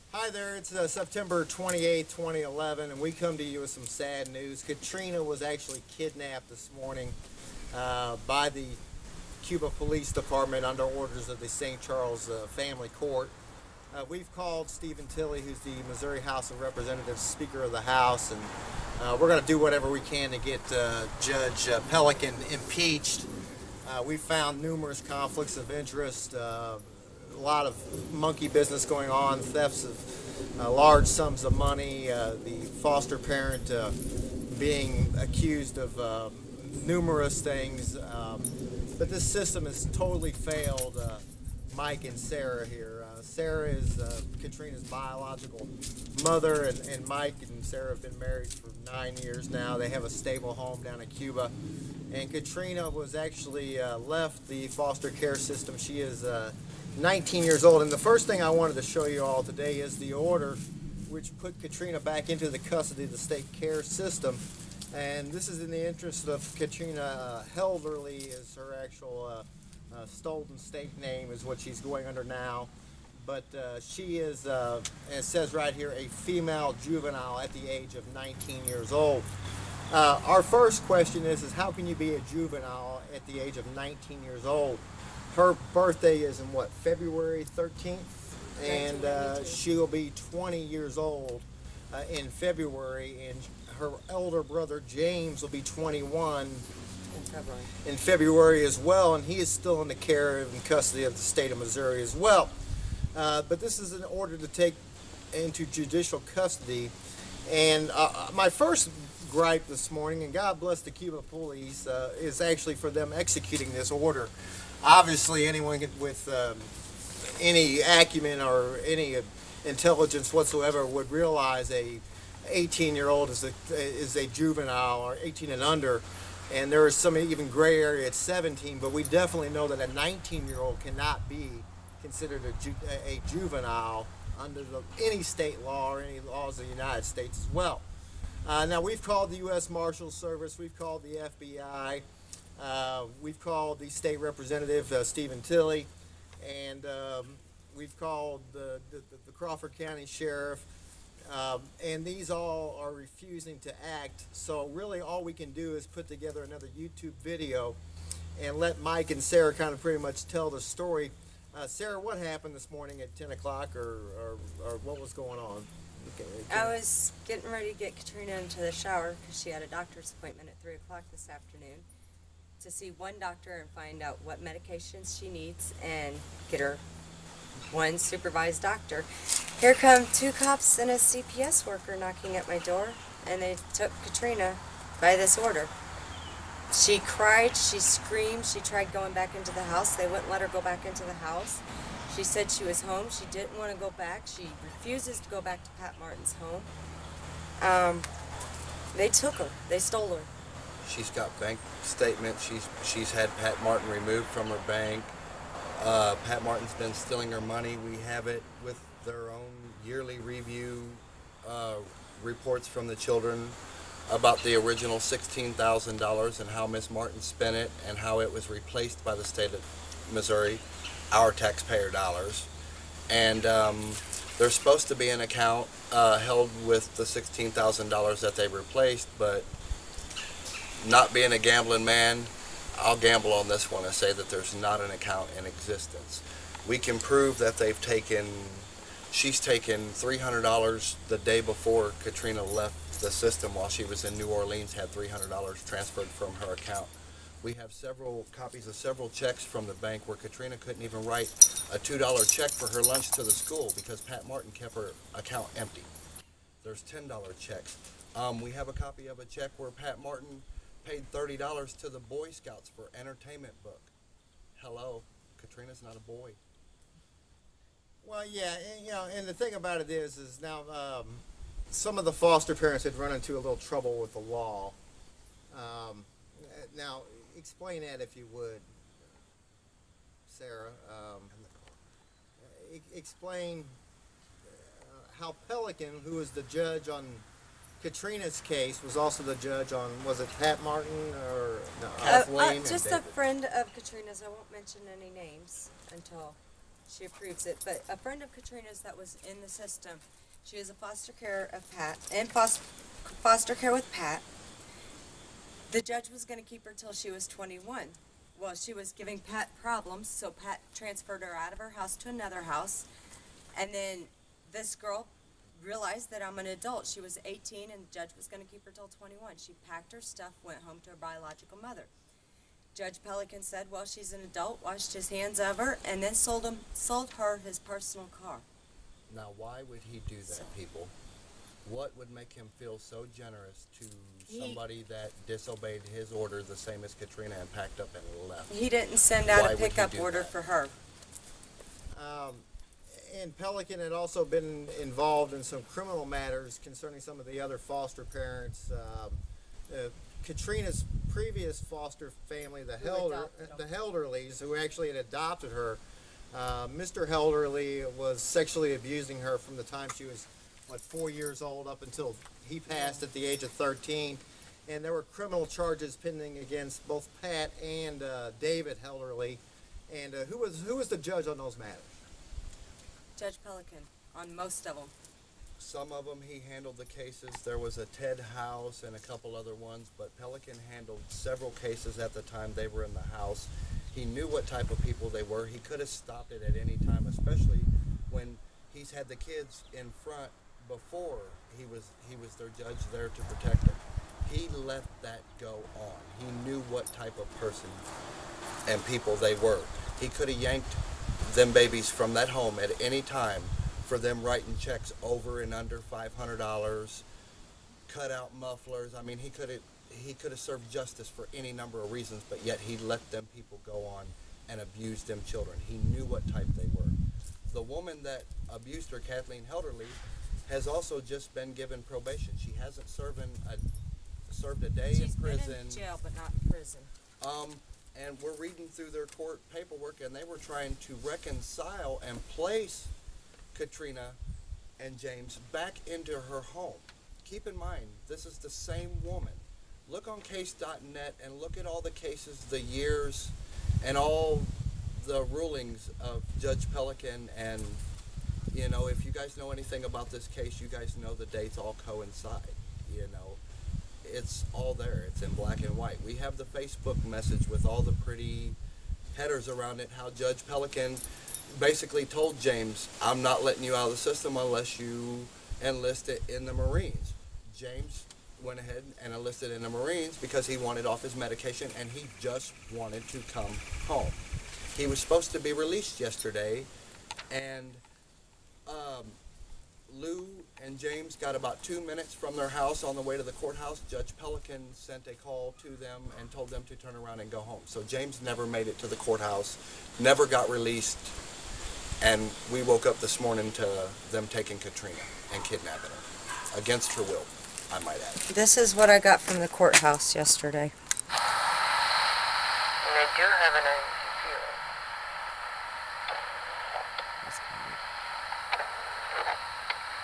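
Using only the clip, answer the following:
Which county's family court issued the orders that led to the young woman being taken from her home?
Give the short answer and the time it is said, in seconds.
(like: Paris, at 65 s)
St. Charles, at 11 s.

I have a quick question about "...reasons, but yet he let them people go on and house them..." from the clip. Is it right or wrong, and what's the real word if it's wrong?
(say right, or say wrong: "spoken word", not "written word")
wrong: "abuse", not "house".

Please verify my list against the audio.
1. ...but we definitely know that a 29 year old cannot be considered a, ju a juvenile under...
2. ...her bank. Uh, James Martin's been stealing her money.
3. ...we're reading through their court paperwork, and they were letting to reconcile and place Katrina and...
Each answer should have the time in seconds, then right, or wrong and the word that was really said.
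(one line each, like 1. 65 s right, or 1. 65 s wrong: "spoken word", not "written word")
1. 128 s wrong: "19", not "29"
2. 204 s wrong: "Pat", not "James"
3. 428 s wrong: "trying", not "letting".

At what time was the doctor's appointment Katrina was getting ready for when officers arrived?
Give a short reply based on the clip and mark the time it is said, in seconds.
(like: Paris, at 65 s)
3 o'clock, at 170 s.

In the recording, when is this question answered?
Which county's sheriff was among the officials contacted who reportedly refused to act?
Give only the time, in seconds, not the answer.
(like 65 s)
149 s.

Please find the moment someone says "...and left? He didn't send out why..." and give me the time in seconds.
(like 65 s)
337 s.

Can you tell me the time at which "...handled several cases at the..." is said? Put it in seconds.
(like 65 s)
380 s.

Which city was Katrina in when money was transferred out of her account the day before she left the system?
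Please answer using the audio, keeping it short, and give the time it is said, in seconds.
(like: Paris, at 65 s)
New Orleans, at 244 s.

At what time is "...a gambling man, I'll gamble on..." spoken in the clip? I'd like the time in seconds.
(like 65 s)
231 s.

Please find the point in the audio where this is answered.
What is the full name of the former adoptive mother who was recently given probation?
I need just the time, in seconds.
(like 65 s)
418 s.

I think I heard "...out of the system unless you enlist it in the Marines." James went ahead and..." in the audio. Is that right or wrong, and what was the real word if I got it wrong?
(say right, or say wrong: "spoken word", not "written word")
right.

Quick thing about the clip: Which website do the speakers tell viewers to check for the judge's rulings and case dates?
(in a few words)
case.net.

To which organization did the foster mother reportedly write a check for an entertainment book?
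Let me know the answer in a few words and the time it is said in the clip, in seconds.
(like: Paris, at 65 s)
Boy Scouts, at 261 s.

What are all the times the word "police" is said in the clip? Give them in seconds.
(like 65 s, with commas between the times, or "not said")
9 s, 111 s.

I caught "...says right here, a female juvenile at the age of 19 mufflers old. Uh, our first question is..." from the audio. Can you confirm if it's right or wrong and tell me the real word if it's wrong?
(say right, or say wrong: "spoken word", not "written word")
wrong: "years", not "mufflers".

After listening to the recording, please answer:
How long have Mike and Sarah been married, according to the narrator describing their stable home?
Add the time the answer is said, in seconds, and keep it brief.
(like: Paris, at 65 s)
9 years, at 48 s.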